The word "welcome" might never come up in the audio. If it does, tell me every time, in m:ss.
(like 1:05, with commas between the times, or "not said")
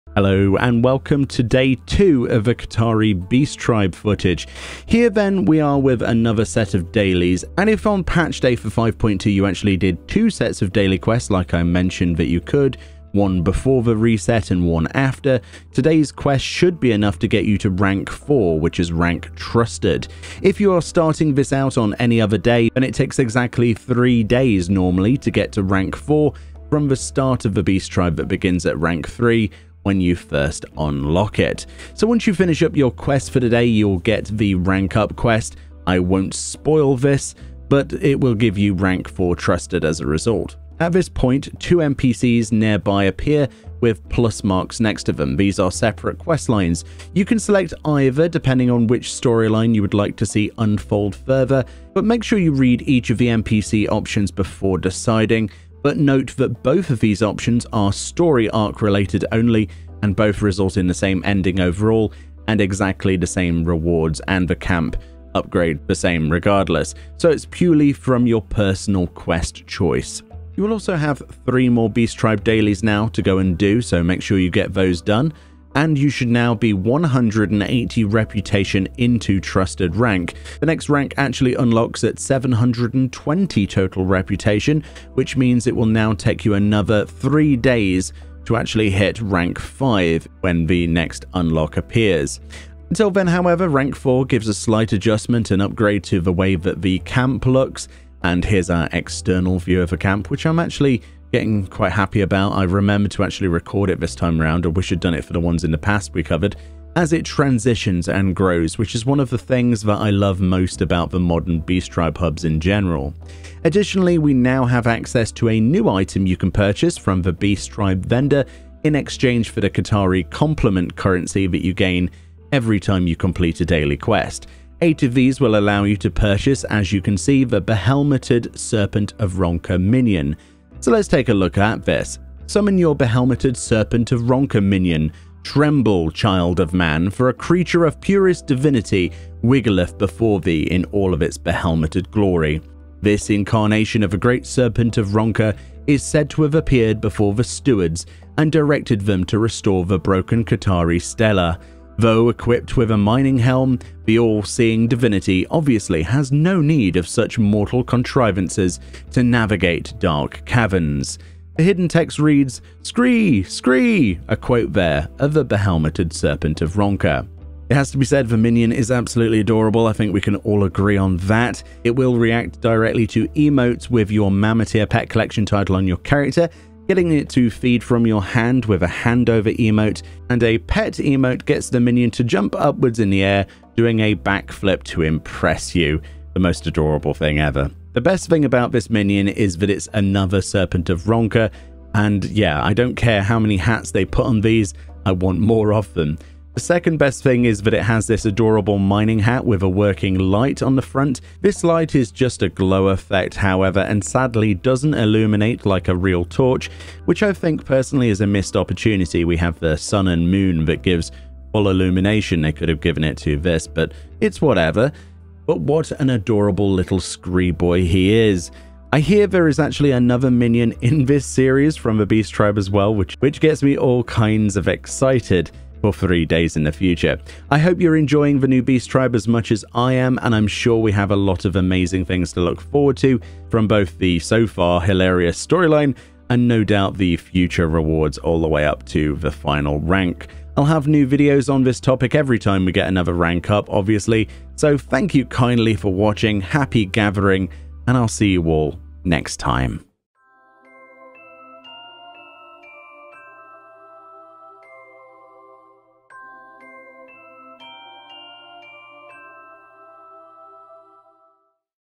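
0:00.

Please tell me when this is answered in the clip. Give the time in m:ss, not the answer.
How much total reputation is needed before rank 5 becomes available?
1:22.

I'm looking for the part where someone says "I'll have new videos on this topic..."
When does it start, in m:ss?
4:00.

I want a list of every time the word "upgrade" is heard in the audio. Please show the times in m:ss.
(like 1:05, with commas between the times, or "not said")
1:05, 1:35.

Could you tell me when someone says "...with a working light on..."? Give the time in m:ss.
3:19.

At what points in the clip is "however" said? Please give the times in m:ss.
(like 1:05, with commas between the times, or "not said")
1:33, 3:23.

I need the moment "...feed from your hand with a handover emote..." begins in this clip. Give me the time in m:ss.
2:57.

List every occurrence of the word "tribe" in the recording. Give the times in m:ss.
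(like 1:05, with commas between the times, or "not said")
0:03, 0:27, 1:12, 1:51, 1:57, 3:42, 3:48.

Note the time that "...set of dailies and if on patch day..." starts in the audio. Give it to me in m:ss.
0:06.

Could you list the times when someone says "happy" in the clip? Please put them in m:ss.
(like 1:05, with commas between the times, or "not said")
1:41, 4:06.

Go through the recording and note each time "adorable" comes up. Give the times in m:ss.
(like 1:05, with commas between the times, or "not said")
2:49, 3:06, 3:18, 3:36.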